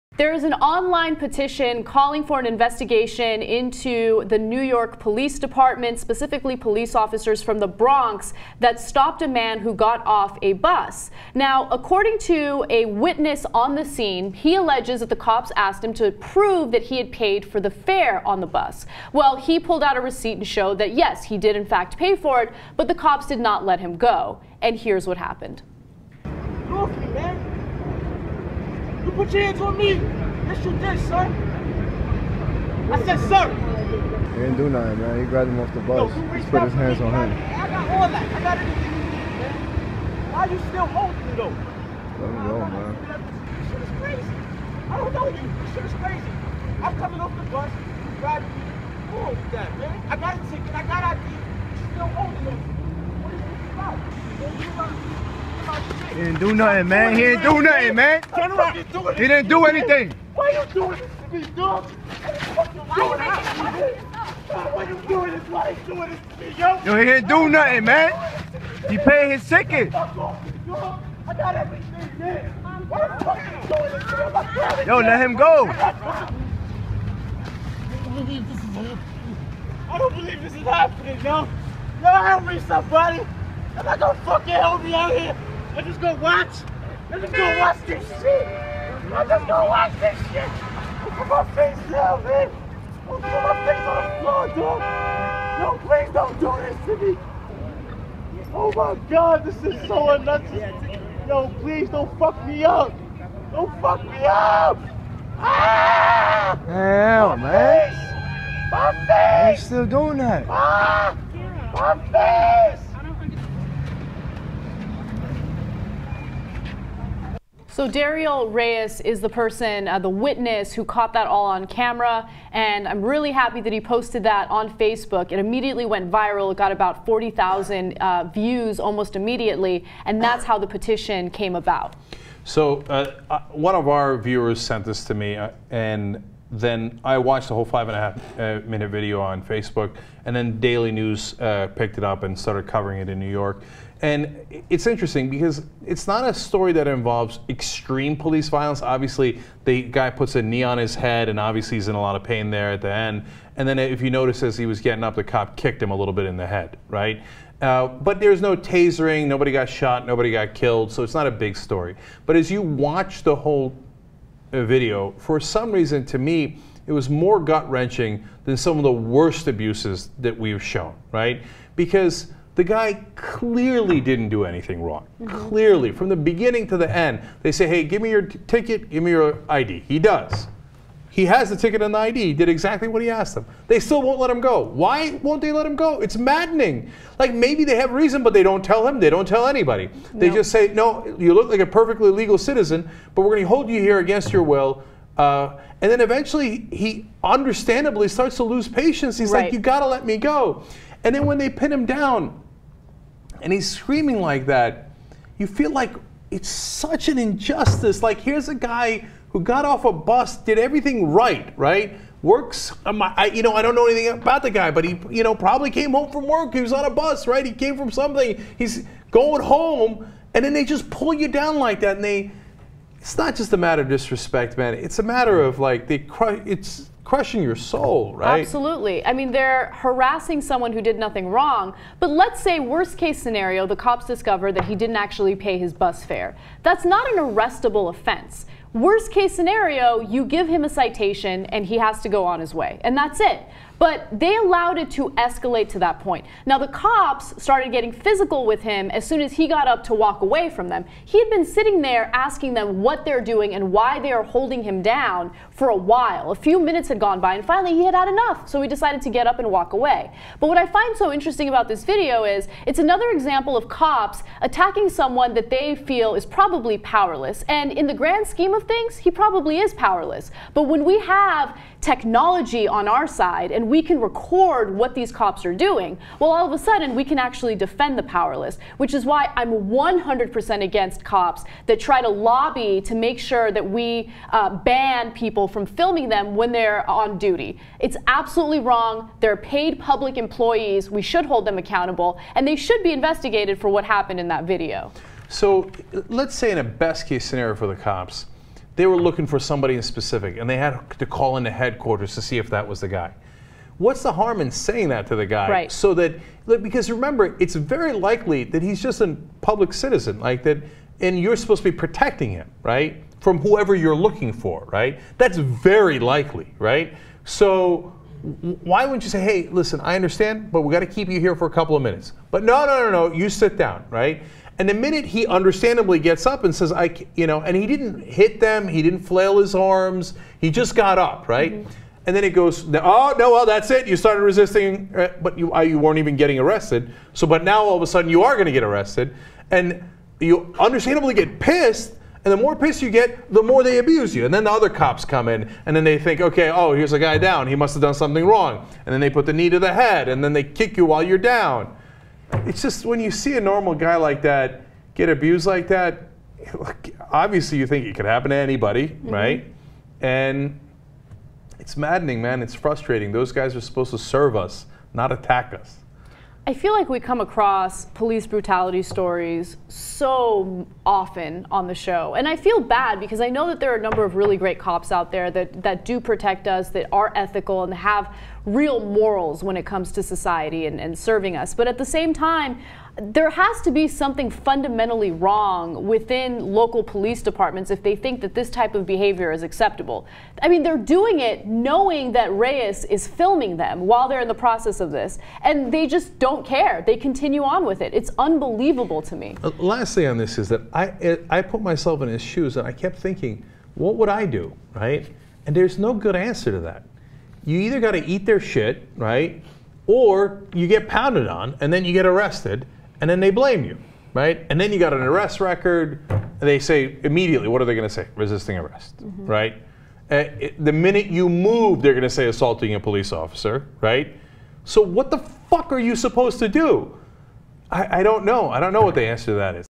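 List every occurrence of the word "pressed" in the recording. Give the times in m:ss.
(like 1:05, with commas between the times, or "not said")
not said.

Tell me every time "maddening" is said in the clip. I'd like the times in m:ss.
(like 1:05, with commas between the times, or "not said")
3:06, 6:01.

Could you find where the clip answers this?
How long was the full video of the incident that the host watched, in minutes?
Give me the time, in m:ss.
2:17.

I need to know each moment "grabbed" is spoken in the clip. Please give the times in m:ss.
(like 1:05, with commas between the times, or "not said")
0:35, 0:48.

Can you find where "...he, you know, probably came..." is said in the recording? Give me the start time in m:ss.
3:34.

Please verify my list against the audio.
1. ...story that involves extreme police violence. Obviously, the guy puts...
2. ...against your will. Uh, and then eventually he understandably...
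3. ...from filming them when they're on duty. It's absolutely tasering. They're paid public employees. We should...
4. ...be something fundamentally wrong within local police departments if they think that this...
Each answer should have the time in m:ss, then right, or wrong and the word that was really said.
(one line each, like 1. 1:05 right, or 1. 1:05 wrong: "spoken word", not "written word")
1. 2:26 right
2. 3:13 right
3. 4:45 wrong: "wrong", not "tasering"
4. 6:23 right.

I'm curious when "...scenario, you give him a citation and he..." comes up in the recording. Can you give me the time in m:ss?
3:59.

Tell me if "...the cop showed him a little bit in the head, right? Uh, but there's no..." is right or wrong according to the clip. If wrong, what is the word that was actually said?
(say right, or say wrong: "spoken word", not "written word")
wrong: "kicked", not "showed".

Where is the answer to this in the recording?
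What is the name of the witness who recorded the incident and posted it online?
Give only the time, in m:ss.
1:57.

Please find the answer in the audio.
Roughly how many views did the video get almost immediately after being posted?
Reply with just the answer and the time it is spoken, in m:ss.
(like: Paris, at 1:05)
40,000, at 2:07.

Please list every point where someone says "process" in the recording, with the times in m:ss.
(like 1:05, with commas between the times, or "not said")
6:34.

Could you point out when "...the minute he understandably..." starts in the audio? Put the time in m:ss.
5:24.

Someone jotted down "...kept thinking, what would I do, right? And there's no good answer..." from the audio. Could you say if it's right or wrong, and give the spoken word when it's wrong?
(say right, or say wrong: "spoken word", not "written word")
right.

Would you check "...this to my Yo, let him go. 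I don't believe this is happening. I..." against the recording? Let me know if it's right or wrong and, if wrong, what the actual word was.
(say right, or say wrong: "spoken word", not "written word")
right.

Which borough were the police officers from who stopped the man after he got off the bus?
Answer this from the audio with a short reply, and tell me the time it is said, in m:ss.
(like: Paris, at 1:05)
The Bronx, at 0:07.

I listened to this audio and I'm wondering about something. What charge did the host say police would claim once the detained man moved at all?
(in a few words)
Assaulting a police officer.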